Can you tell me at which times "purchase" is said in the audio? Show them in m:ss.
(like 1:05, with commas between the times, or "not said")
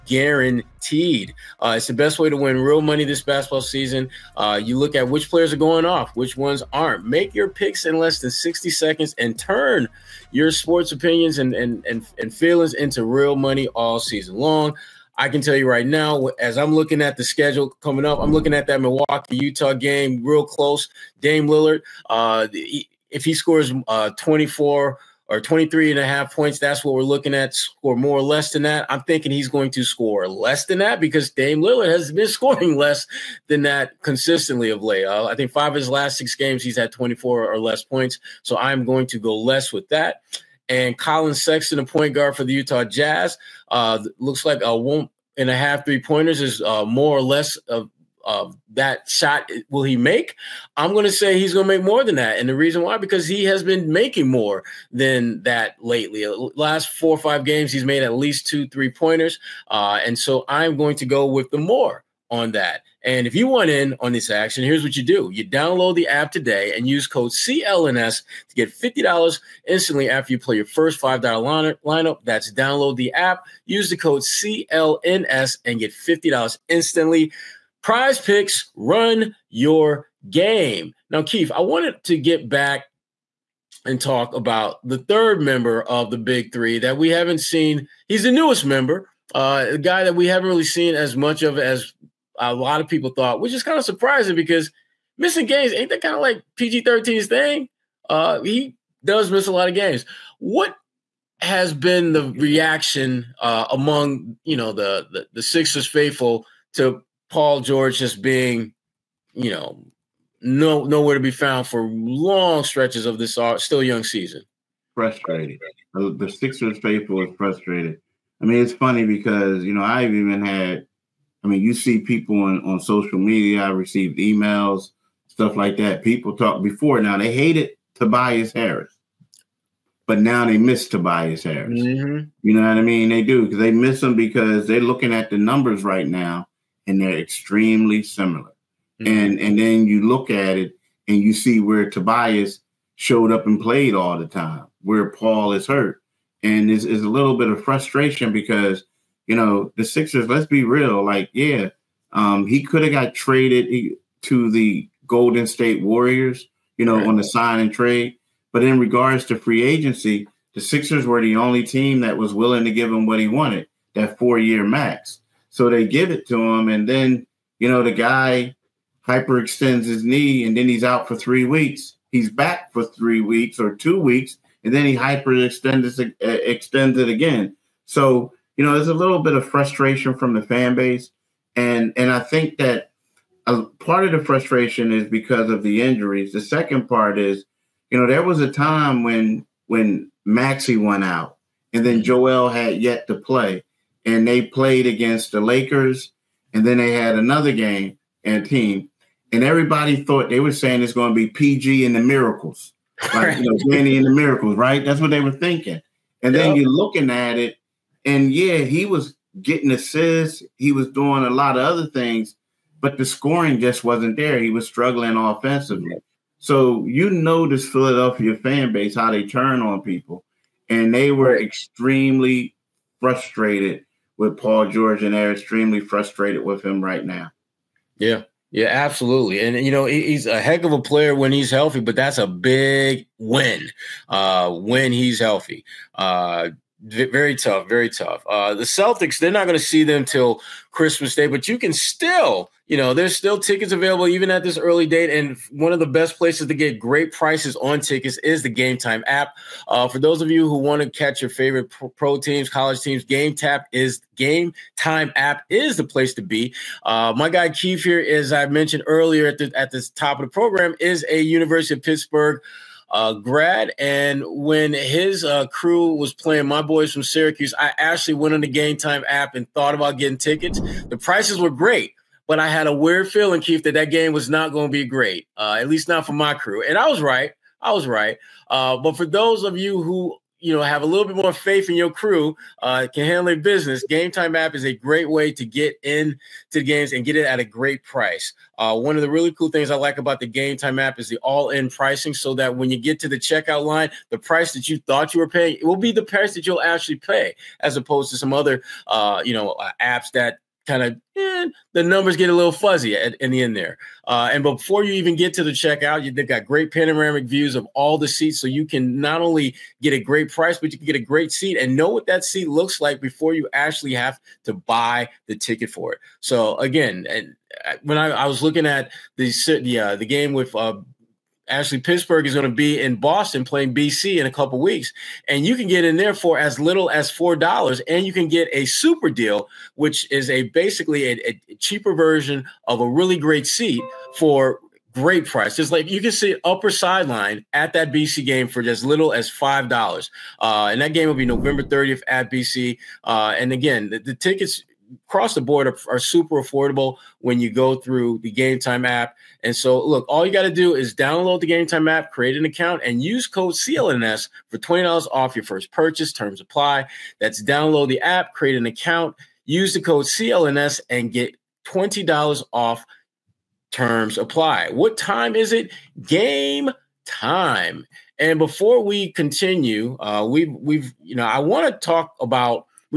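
5:55.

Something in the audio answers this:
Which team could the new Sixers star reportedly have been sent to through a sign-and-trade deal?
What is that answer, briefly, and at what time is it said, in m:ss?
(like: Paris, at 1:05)
Golden State Warriors, at 2:35.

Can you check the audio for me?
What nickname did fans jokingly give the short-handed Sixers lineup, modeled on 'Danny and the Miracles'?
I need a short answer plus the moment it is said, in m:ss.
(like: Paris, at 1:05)
PG and the Miracles, at 3:21.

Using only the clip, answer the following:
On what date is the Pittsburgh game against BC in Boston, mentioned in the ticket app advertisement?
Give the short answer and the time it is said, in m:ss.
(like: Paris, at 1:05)
November 30, at 5:41.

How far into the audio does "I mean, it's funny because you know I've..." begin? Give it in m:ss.
1:58.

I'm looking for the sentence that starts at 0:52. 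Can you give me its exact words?
And the reason why, because he has been making more than that lately.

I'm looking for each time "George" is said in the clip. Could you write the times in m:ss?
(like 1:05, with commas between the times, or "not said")
1:47, 3:44.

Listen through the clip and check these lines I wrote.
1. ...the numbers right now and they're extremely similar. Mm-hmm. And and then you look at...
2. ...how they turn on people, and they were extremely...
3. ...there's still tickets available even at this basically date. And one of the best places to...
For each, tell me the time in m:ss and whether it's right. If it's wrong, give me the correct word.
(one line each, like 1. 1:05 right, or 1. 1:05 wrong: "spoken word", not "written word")
1. 2:15 right
2. 3:38 right
3. 4:02 wrong: "early", not "basically".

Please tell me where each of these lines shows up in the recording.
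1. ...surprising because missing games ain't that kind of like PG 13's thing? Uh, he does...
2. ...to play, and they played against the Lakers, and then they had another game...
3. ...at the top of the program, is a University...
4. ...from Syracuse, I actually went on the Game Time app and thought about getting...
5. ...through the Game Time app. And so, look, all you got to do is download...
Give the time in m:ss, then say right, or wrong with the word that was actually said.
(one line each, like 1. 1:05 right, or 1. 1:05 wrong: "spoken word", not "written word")
1. 1:33 right
2. 3:13 right
3. 4:19 right
4. 4:26 right
5. 5:47 right.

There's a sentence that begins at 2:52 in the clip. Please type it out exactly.
He's back for three weeks or two weeks.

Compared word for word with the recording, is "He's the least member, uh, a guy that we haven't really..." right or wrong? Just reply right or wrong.
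wrong.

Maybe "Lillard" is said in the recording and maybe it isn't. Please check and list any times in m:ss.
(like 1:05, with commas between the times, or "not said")
0:21, 0:31.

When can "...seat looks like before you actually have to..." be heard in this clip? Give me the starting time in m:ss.
5:12.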